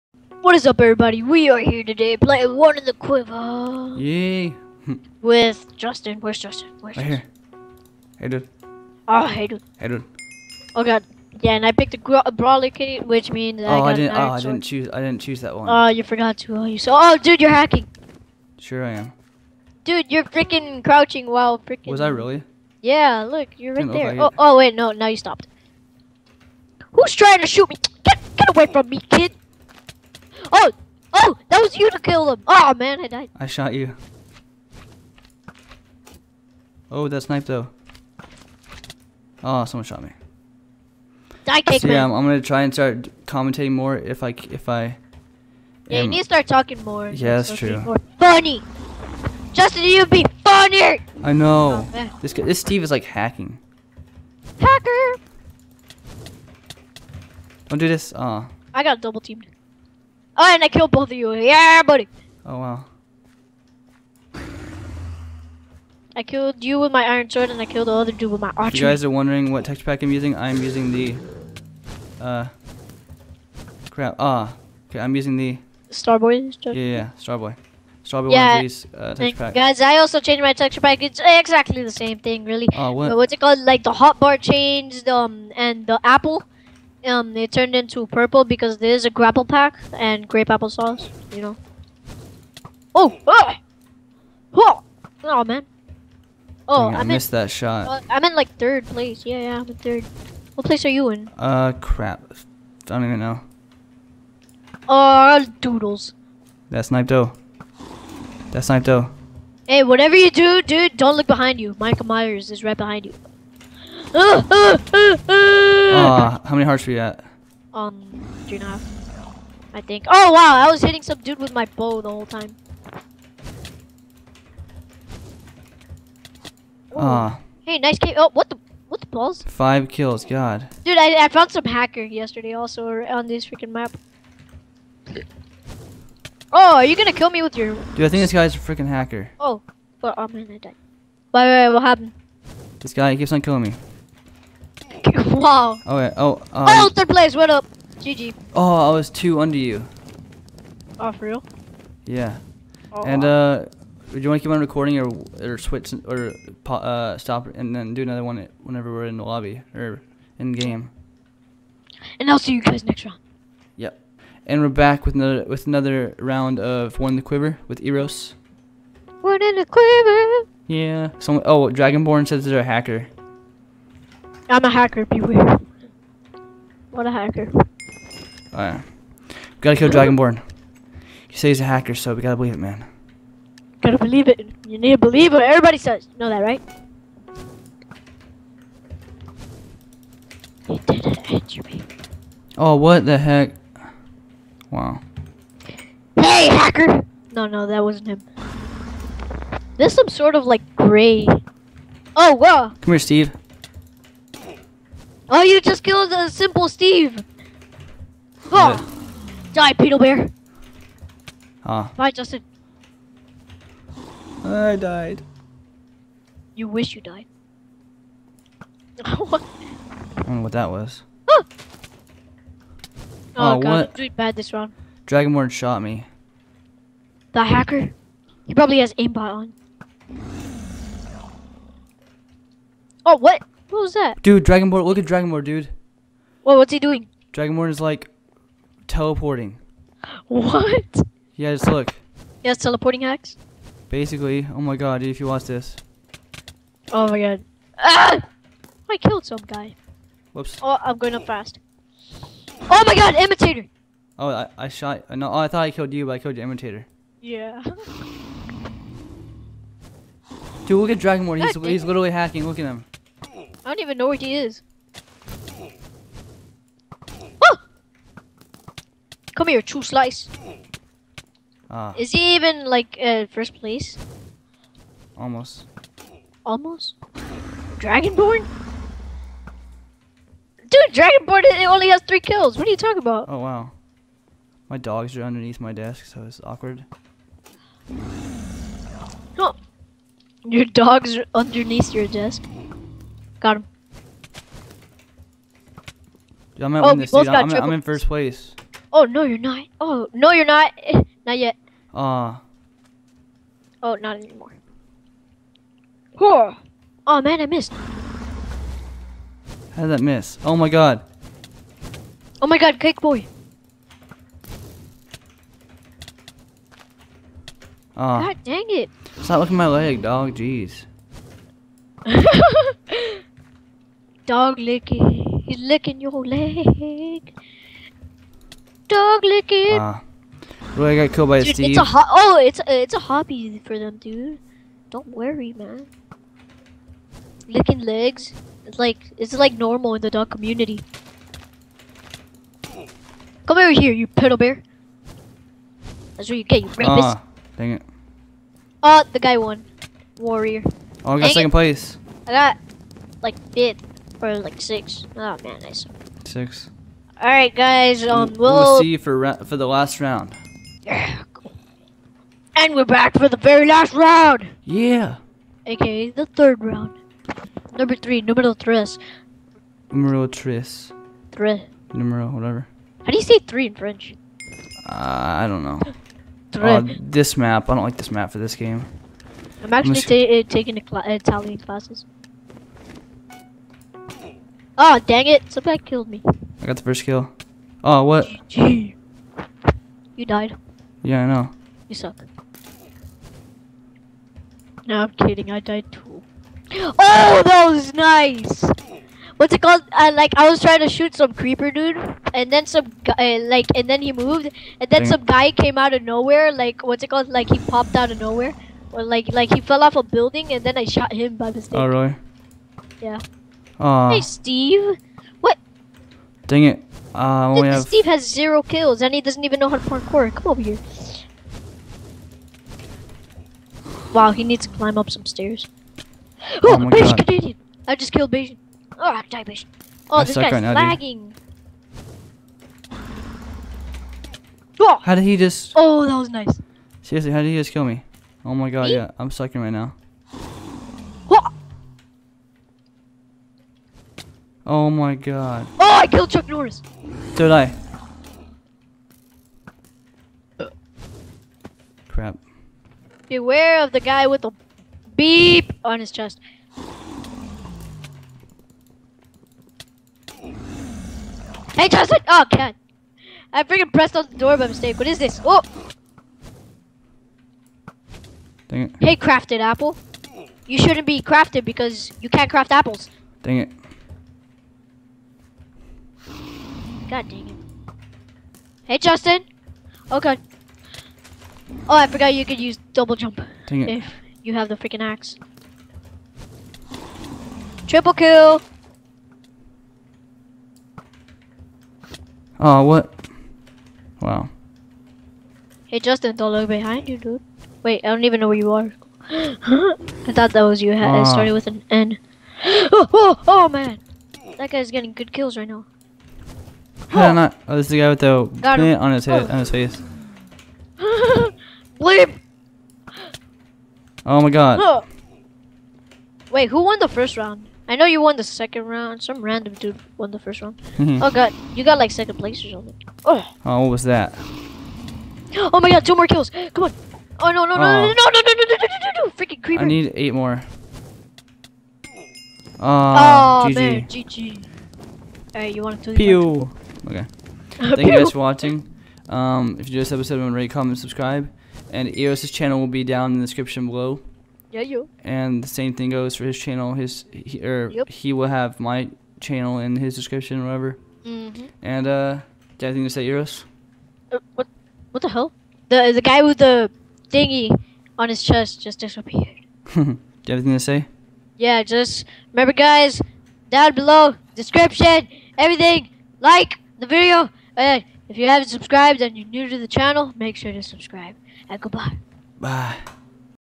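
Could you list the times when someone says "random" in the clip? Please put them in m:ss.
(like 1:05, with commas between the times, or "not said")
8:39.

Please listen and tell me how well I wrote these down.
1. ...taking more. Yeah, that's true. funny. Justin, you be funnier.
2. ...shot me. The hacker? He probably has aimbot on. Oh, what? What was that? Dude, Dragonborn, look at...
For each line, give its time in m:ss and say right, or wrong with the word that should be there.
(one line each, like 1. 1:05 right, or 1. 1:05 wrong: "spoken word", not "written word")
1. 0:46 wrong: "talking", not "taking"
2. 3:45 right.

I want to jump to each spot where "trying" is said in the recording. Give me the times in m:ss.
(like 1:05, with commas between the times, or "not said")
0:27, 6:40.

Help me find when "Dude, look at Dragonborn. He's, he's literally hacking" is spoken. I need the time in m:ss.
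4:20.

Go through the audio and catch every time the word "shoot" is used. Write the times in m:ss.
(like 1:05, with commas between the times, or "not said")
0:27, 6:40.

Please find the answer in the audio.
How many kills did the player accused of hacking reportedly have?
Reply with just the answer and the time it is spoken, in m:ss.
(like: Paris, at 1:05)
3, at 4:42.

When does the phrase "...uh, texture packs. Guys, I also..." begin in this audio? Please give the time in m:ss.
1:18.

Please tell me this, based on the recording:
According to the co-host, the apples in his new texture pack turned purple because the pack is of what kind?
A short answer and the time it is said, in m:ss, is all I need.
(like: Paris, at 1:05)
grapple pack, at 1:29.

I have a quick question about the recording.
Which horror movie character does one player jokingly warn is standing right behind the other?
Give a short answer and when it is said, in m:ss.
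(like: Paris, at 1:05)
Michael Myers, at 1:51.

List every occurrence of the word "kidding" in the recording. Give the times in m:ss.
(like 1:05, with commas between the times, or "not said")
6:35.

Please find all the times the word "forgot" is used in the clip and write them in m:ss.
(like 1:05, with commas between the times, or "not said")
0:16, 8:02.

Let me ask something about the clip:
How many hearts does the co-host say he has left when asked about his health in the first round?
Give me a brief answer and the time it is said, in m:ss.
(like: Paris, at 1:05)
3 and a half, at 1:58.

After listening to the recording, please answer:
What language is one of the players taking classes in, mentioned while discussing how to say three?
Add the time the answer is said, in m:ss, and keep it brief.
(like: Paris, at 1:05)
Italian, at 6:21.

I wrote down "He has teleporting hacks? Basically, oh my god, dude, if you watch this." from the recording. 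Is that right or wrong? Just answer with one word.
right.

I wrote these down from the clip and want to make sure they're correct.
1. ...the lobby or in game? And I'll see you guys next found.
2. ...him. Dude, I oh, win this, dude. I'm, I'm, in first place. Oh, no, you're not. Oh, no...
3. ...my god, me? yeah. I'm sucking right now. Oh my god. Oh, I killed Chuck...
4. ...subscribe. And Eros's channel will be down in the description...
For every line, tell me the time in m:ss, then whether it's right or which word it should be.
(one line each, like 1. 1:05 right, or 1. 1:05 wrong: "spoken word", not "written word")
1. 2:39 wrong: "round", not "found"
2. 4:53 right
3. 7:18 right
4. 9:00 right.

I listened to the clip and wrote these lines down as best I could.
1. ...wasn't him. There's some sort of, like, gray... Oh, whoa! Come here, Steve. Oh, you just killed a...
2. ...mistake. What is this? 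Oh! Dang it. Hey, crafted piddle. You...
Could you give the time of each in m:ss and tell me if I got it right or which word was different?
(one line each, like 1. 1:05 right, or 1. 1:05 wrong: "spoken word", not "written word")
1. 3:17 right
2. 7:44 wrong: "apple", not "piddle".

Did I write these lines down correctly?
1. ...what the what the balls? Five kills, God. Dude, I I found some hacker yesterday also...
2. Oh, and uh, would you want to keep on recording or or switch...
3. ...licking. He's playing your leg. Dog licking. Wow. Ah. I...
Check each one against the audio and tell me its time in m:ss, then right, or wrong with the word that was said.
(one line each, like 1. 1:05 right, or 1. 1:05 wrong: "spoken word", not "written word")
1. 2:08 right
2. 2:32 right
3. 5:24 wrong: "licking", not "playing".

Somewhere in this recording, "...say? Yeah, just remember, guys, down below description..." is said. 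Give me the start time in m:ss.
9:20.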